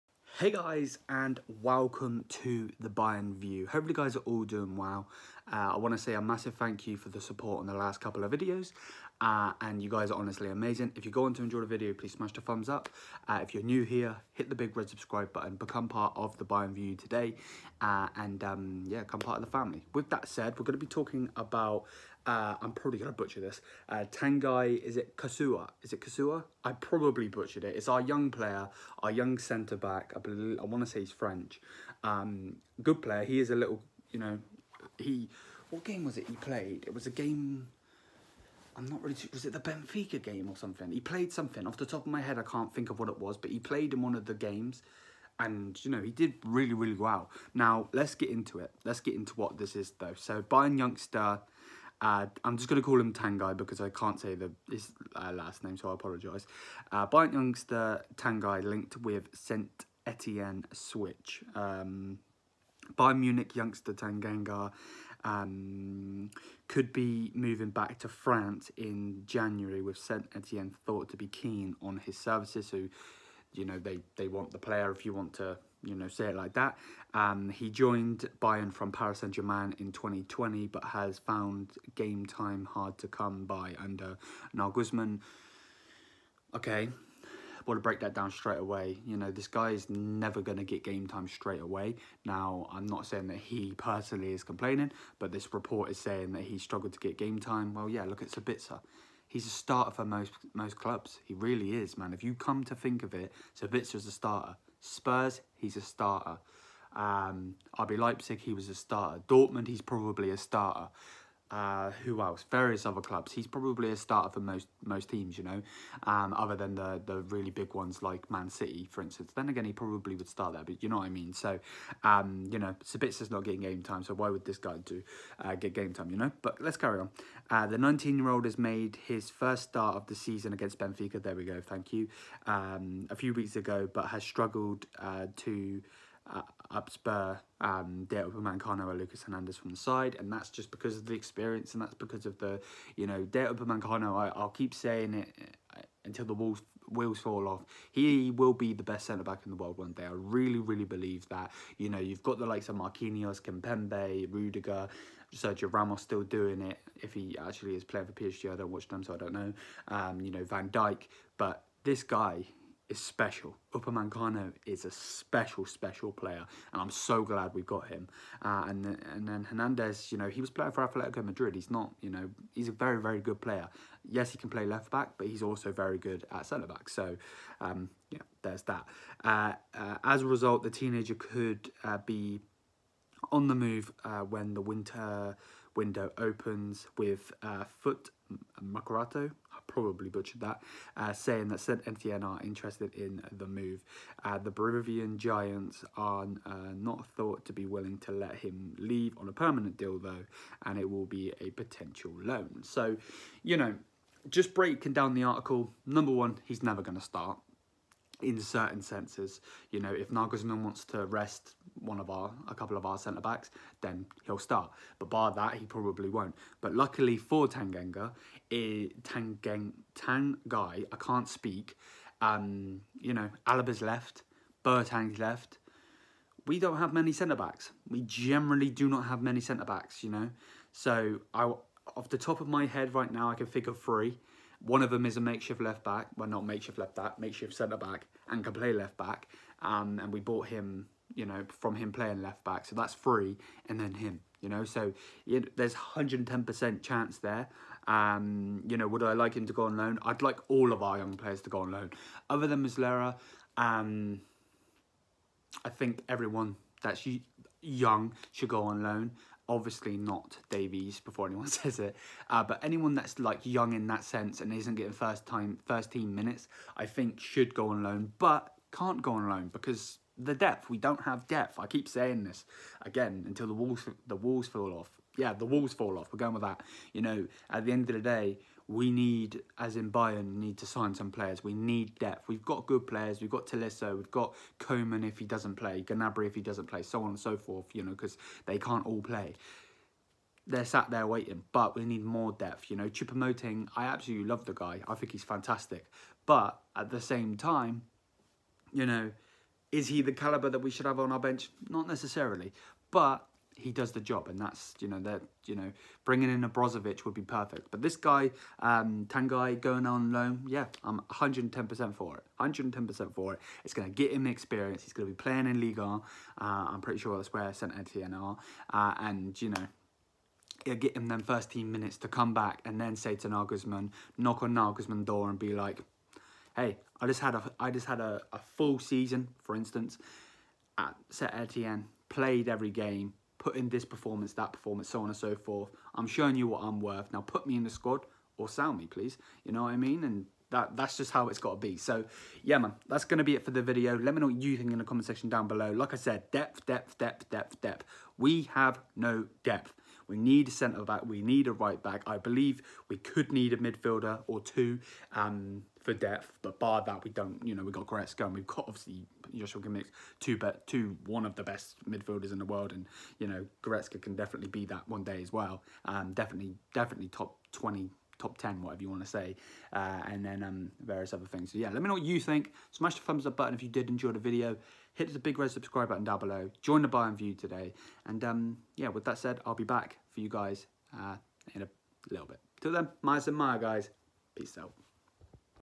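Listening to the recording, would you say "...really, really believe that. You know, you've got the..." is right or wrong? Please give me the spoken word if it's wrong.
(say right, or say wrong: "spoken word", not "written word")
right.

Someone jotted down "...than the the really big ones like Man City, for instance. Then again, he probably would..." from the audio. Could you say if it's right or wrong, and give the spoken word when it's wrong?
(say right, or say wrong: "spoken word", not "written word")
right.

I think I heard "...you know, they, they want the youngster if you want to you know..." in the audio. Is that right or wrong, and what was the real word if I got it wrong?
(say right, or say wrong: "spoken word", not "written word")
wrong: "player", not "youngster".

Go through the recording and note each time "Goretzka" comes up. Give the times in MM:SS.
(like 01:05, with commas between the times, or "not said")
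05:57, 06:03.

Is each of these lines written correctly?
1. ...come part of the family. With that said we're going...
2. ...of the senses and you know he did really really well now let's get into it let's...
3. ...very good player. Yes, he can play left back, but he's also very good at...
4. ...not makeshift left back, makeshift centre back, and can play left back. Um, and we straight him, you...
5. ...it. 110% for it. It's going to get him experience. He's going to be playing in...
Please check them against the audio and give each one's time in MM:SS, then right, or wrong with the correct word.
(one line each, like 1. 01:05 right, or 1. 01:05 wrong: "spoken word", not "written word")
1. 00:19 right
2. 00:44 wrong: "games", not "senses"
3. 02:53 right
4. 03:56 wrong: "bought", not "straight"
5. 05:12 right.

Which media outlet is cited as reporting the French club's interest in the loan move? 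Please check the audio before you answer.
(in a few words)
Foot Mercato.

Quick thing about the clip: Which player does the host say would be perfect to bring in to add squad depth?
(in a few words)
Brozovic.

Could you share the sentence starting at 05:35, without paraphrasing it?
I'm showing you what I'm worth.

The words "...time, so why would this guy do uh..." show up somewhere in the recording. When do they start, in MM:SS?
02:03.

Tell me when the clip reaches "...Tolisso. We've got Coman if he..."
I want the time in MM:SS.
04:43.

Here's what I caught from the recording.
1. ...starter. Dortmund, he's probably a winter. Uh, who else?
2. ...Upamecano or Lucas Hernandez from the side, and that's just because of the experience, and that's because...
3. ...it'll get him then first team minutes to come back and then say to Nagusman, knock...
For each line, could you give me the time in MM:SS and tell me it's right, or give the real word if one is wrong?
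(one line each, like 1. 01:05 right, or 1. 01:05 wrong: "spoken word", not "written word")
1. 01:48 wrong: "starter", not "winter"
2. 02:18 right
3. 05:20 right.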